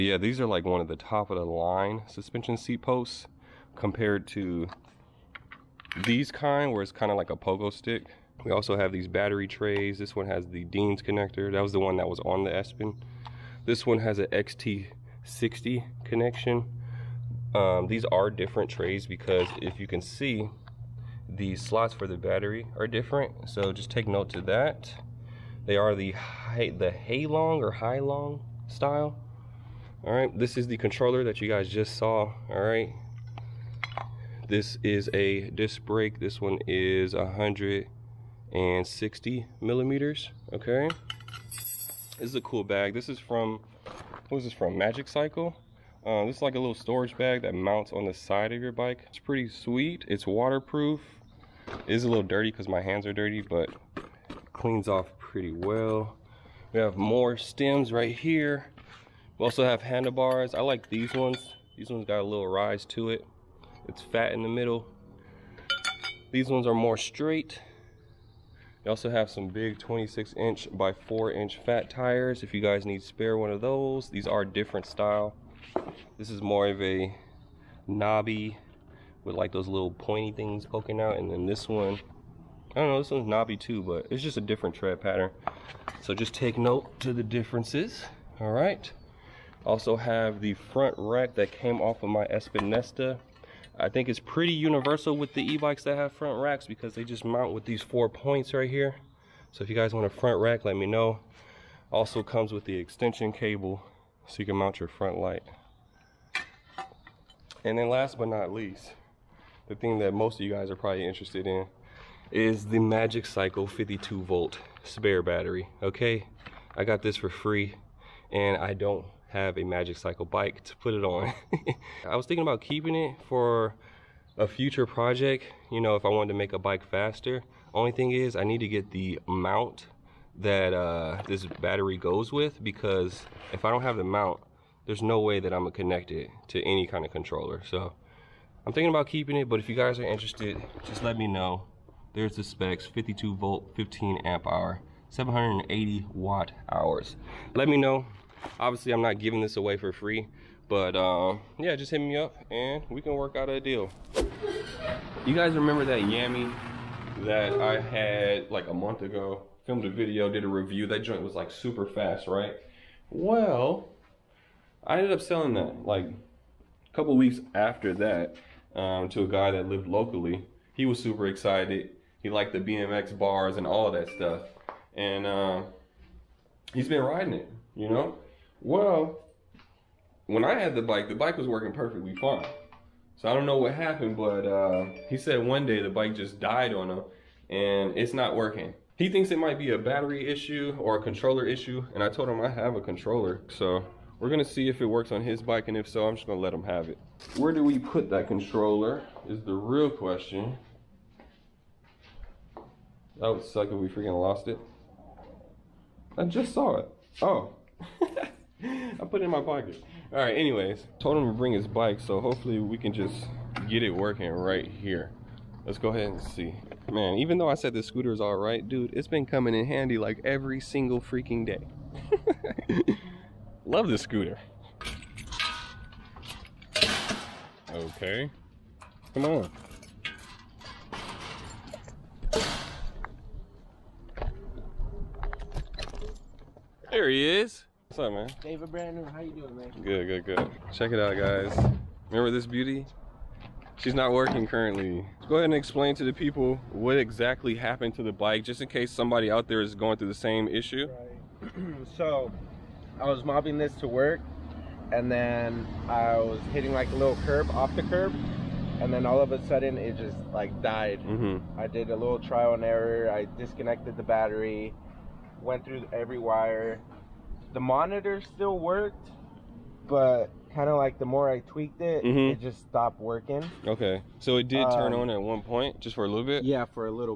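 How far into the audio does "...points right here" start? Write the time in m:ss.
1:38.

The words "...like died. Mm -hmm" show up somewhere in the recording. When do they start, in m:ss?
4:20.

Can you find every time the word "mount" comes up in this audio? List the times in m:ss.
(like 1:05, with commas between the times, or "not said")
0:47, 1:37, 1:44, 2:09, 2:14.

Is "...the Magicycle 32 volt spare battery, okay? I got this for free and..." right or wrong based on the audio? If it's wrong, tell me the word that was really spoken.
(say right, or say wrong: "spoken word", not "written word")
wrong: "52", not "32".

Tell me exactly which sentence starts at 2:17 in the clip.
So I'm thinking about keeping it, but if you guys are interested, just let me know.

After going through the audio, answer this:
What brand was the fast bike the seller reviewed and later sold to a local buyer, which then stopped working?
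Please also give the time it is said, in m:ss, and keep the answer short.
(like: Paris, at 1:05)
Yamee, at 2:36.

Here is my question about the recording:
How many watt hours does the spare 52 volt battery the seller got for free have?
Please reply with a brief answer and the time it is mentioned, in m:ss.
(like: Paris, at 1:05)
780, at 2:25.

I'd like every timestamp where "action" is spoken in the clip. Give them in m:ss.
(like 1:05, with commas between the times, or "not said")
not said.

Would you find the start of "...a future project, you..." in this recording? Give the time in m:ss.
2:04.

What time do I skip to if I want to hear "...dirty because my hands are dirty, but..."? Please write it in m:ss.
0:52.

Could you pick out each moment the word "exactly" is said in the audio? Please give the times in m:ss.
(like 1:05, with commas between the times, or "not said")
4:06.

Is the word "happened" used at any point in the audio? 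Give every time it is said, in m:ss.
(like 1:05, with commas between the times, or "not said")
3:03, 4:07.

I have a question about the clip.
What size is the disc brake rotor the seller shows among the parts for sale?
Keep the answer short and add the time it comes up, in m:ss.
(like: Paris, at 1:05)
160 millimeters, at 0:37.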